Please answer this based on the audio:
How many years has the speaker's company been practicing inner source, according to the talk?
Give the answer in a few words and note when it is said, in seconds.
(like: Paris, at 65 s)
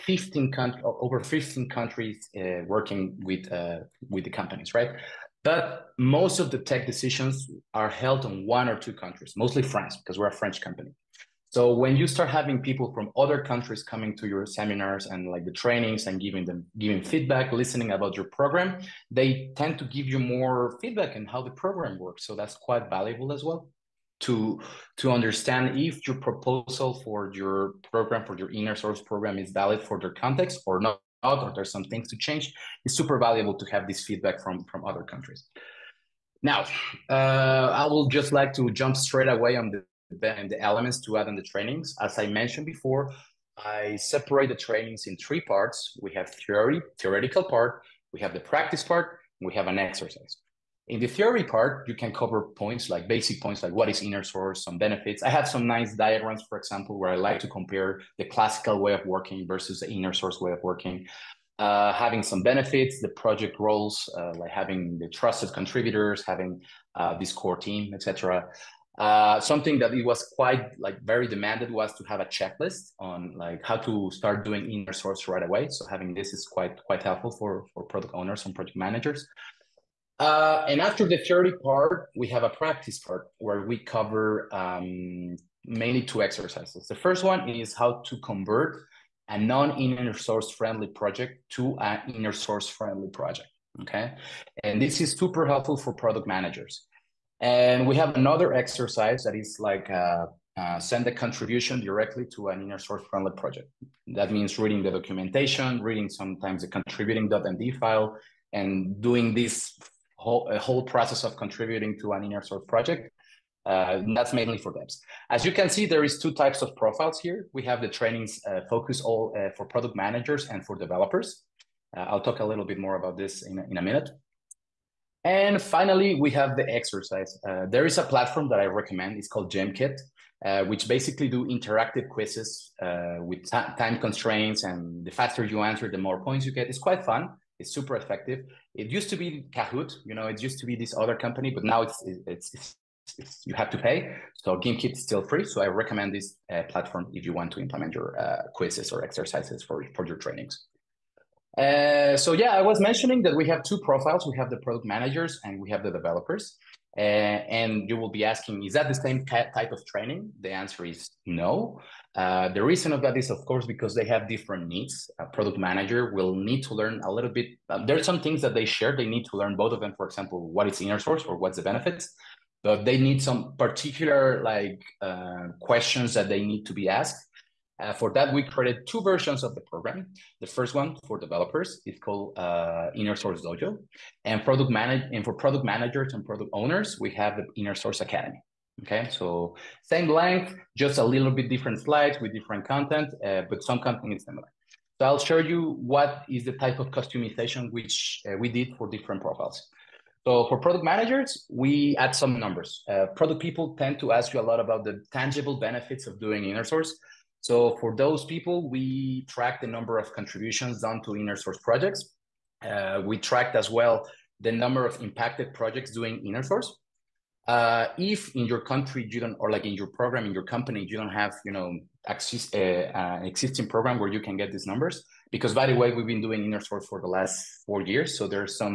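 4 years, at 227 s.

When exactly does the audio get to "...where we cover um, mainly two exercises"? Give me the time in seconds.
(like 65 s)
83 s.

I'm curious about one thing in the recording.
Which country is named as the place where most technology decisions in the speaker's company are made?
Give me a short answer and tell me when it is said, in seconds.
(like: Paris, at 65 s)
France, at 9 s.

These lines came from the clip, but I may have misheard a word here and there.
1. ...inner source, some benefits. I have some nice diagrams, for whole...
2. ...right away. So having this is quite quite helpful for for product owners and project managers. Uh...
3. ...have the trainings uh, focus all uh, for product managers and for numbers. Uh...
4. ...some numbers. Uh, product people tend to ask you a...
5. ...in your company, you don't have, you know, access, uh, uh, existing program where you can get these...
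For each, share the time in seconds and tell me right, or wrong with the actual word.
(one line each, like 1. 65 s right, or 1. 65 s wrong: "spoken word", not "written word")
1. 54 s wrong: "example", not "whole"
2. 75 s right
3. 117 s wrong: "developers", not "numbers"
4. 202 s right
5. 220 s right.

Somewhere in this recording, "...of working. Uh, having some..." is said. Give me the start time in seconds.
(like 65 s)
60 s.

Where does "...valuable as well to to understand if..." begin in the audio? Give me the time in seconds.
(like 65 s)
22 s.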